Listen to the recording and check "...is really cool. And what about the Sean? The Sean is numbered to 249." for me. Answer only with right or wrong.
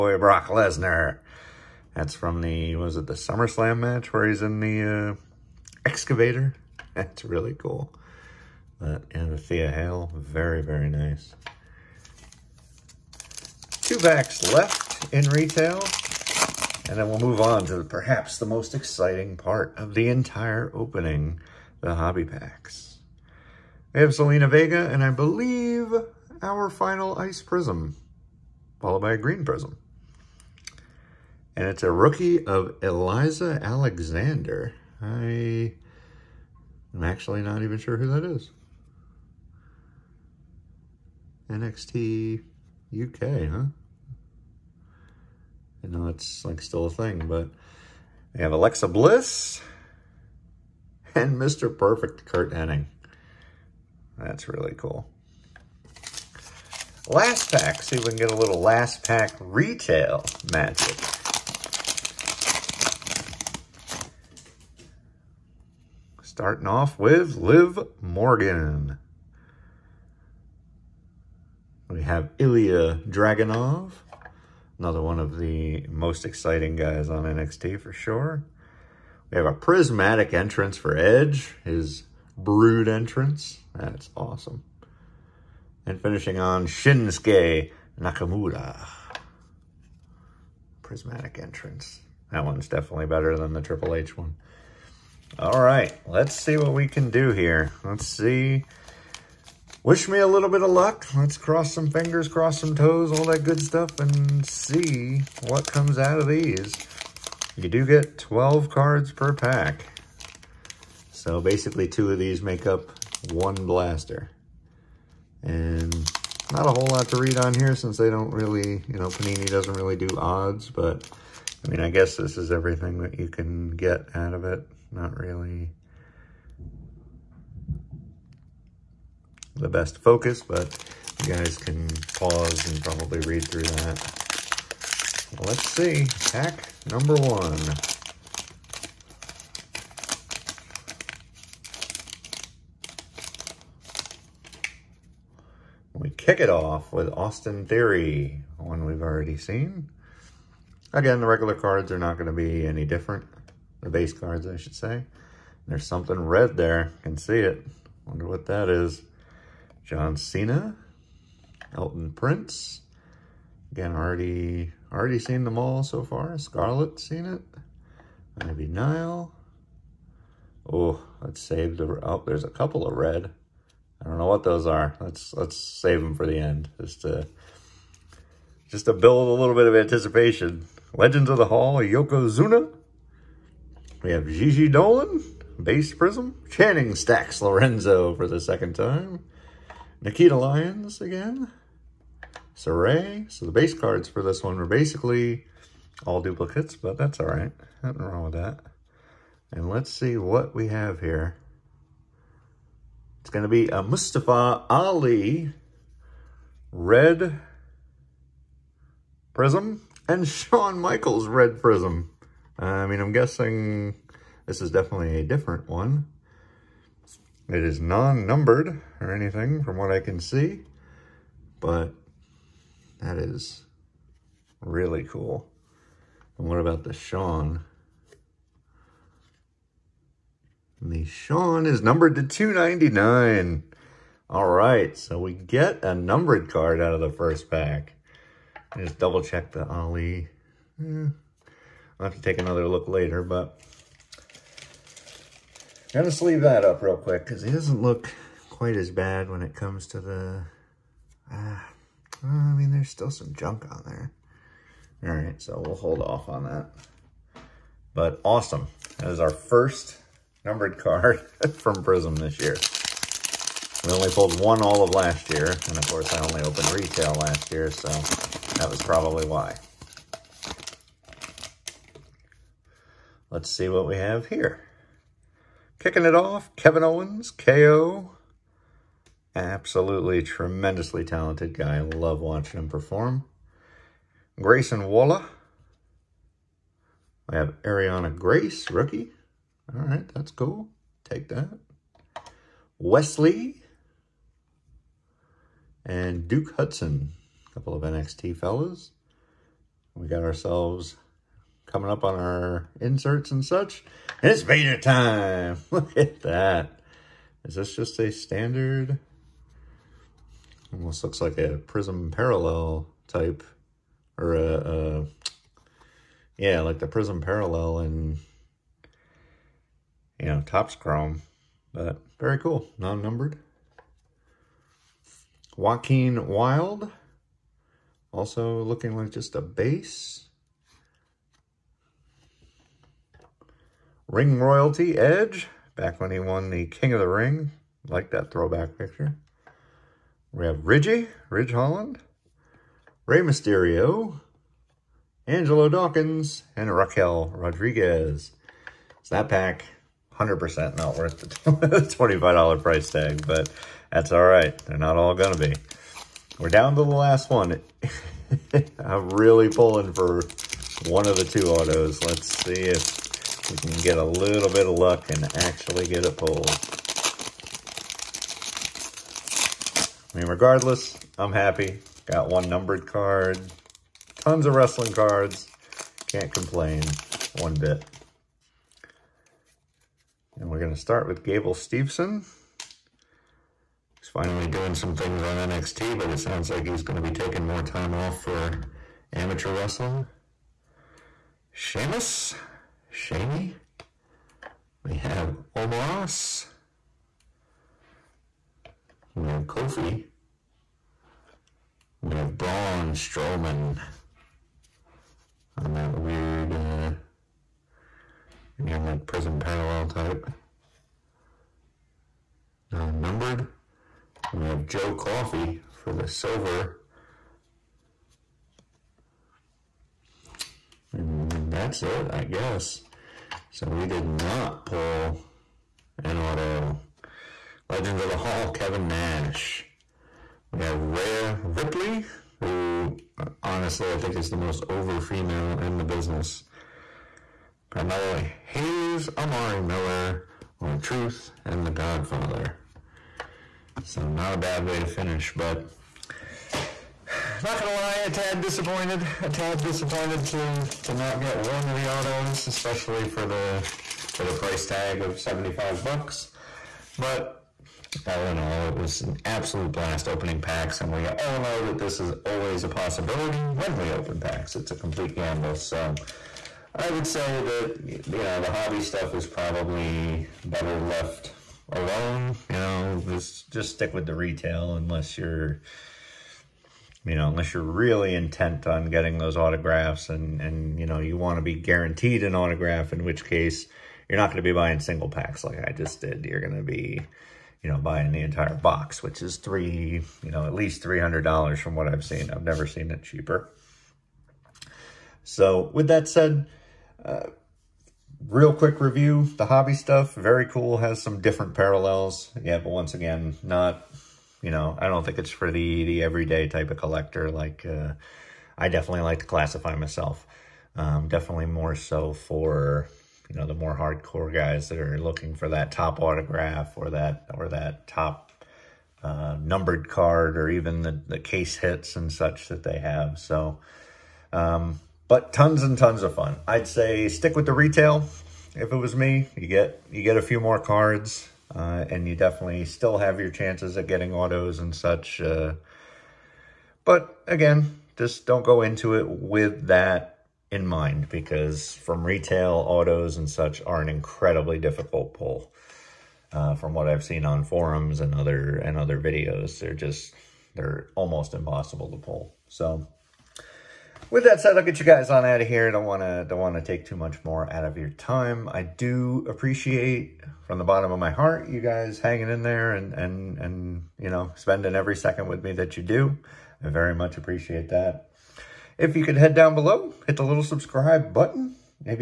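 wrong.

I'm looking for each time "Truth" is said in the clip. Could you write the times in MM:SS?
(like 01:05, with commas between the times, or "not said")
07:20.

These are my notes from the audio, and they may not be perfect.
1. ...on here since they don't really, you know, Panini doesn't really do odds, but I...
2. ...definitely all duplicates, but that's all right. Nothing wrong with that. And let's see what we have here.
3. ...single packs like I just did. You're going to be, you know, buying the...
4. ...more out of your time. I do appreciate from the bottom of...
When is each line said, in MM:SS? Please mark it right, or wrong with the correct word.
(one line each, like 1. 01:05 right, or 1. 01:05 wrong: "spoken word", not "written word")
1. 01:57 right
2. 03:14 wrong: "basically", not "definitely"
3. 08:04 right
4. 09:17 right.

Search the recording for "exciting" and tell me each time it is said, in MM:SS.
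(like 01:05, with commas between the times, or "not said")
00:18, 01:16.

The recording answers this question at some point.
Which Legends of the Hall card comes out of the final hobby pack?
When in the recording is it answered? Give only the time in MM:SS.
07:08.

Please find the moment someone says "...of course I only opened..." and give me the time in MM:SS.
04:25.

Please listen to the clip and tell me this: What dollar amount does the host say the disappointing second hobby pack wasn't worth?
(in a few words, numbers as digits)
$25.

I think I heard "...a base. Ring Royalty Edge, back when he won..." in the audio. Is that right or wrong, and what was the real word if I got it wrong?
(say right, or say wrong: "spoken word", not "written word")
right.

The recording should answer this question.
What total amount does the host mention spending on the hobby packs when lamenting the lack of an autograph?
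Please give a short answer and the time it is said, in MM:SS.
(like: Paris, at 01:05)
$75, at 07:35.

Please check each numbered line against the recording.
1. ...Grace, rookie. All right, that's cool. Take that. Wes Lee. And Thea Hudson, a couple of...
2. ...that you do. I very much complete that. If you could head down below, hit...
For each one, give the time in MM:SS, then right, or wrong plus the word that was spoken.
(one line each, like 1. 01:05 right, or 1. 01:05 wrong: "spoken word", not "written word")
1. 04:48 wrong: "Duke", not "Thea"
2. 09:25 wrong: "appreciate", not "complete".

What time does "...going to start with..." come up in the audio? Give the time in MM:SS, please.
06:20.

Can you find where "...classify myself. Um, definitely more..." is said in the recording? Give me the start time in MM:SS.
08:29.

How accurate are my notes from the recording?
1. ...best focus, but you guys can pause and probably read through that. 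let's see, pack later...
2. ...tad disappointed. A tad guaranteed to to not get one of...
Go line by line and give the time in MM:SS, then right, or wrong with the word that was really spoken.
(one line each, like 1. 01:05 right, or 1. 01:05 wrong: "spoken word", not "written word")
1. 02:09 wrong: "number", not "later"
2. 07:28 wrong: "disappointed", not "guaranteed".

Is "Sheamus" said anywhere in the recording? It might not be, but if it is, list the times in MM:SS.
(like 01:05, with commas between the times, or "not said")
06:31.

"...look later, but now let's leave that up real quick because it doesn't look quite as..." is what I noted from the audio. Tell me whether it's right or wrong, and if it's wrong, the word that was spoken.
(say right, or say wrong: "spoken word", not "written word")
right.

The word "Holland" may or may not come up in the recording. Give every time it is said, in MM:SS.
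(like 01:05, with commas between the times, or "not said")
05:41.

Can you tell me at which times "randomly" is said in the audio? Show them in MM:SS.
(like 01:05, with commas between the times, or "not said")
not said.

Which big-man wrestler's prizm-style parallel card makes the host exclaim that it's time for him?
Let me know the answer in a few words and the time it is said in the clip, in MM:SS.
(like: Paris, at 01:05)
Vader, at 05:04.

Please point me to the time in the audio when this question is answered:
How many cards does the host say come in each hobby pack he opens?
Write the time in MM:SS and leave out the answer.
01:48.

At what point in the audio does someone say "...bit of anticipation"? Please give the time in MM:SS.
02:59.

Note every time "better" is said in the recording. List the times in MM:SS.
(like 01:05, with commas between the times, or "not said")
01:33, 07:50.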